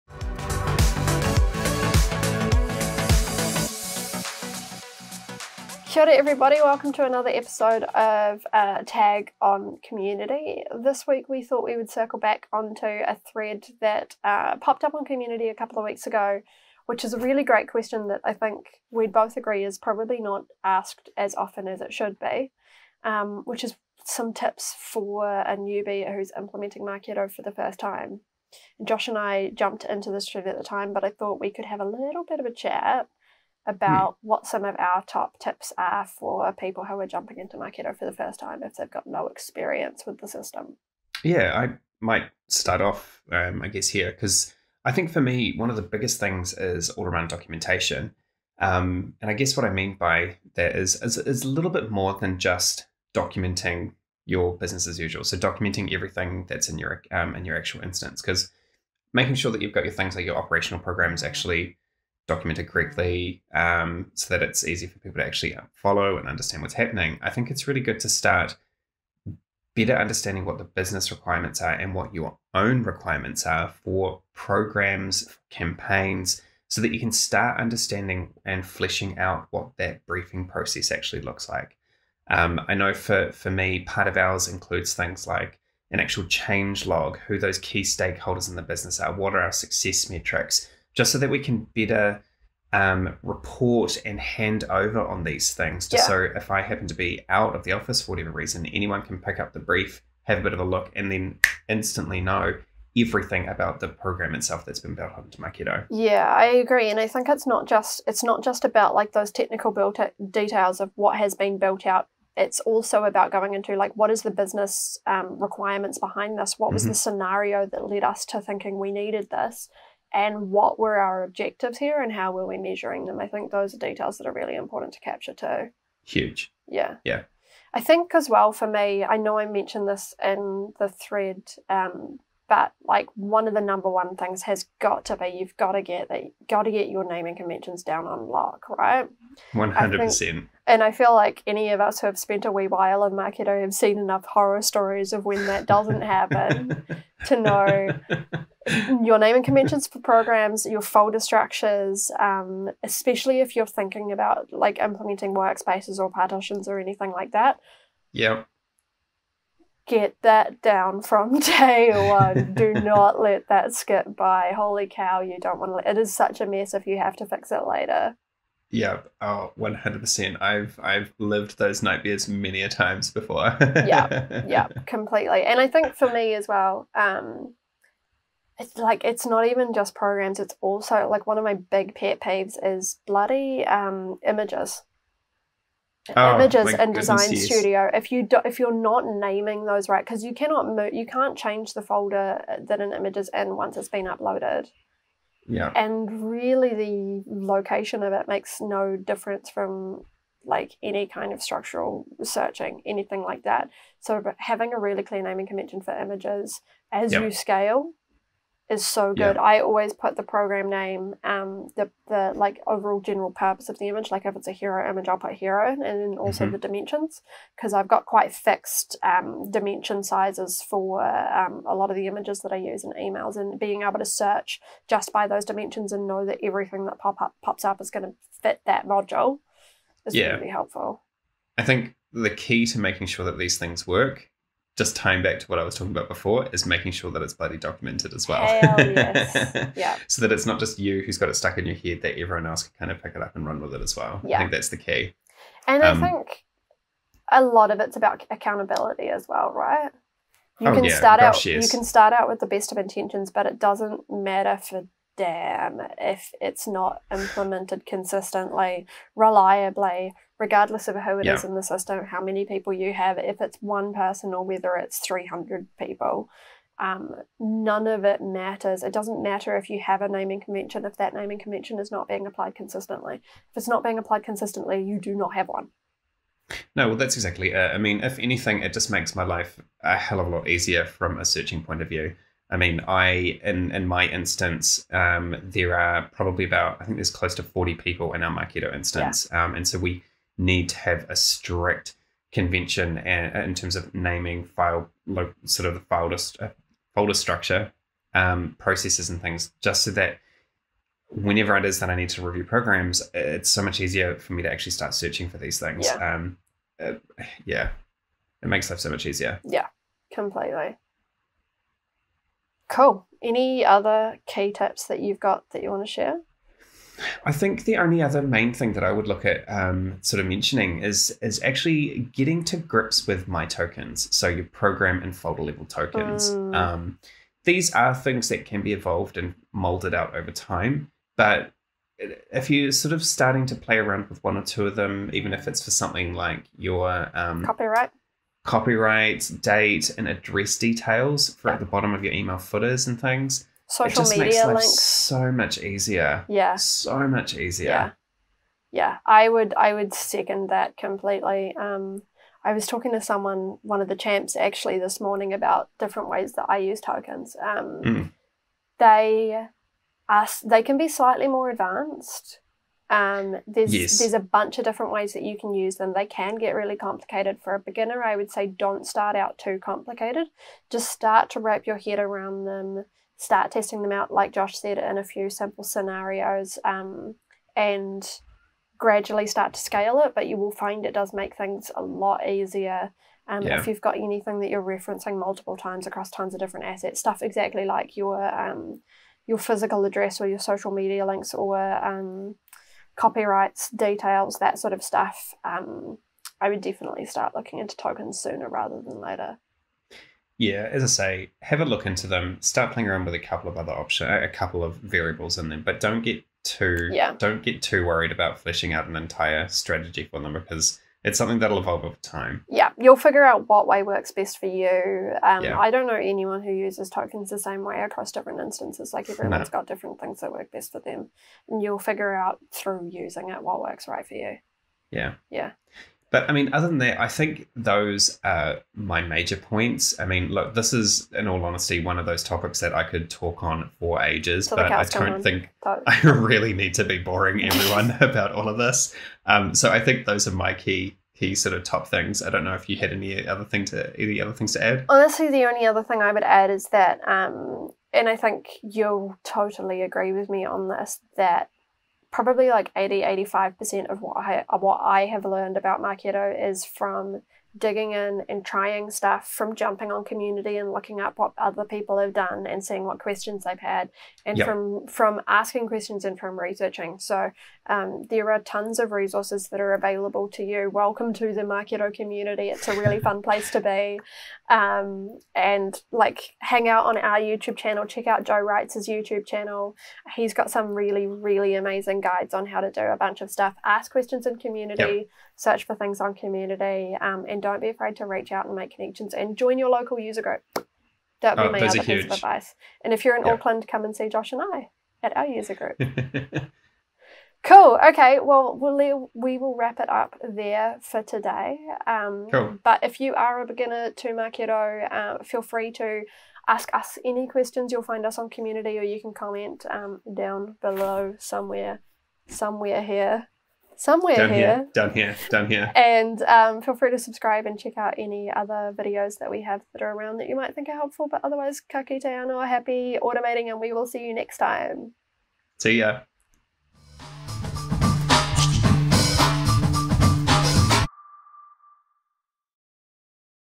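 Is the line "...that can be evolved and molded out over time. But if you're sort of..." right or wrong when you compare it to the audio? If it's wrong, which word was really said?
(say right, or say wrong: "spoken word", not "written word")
right.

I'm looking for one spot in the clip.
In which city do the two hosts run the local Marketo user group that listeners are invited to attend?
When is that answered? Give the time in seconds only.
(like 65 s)
493 s.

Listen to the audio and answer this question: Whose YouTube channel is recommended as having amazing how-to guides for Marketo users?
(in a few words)
Joe Wright.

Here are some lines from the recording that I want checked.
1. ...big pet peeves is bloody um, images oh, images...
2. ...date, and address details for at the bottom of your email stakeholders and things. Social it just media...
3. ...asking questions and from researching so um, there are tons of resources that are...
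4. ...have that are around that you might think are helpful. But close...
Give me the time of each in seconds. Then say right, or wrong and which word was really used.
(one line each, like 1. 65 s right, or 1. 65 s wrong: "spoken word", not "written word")
1. 181 s right
2. 339 s wrong: "footers", not "stakeholders"
3. 465 s right
4. 519 s wrong: "otherwise", not "close".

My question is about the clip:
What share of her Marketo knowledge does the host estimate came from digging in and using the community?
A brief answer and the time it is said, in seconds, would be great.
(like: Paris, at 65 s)
80 to 85%, at 452 s.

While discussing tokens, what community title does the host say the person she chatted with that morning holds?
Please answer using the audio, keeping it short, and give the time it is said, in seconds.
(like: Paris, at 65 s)
champs, at 353 s.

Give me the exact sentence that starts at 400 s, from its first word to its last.
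Yeah, as I say, have a look into them.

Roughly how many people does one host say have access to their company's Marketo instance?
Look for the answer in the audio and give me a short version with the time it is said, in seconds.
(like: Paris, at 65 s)
forty, at 287 s.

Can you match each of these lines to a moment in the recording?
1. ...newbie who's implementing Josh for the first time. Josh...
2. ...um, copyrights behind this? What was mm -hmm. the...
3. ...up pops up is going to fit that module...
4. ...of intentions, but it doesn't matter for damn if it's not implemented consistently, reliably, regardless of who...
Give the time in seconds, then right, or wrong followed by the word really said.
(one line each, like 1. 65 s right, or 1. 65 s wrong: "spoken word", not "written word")
1. 25 s wrong: "Marketo", not "Josh"
2. 115 s wrong: "requirements", not "copyrights"
3. 227 s right
4. 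252 s right.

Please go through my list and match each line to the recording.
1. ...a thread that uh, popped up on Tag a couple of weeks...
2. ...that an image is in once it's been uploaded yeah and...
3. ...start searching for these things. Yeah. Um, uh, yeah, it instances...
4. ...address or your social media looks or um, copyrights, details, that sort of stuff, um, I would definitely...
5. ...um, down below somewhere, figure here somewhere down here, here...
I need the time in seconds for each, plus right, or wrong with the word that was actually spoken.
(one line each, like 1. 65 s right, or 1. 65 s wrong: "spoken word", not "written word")
1. 12 s wrong: "Community", not "Tag"
2. 192 s right
3. 304 s wrong: "makes", not "instances"
4. 389 s wrong: "links", not "looks"
5. 509 s wrong: "somewhere", not "figure".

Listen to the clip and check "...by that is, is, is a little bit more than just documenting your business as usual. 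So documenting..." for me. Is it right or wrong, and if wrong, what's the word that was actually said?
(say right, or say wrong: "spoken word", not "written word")
right.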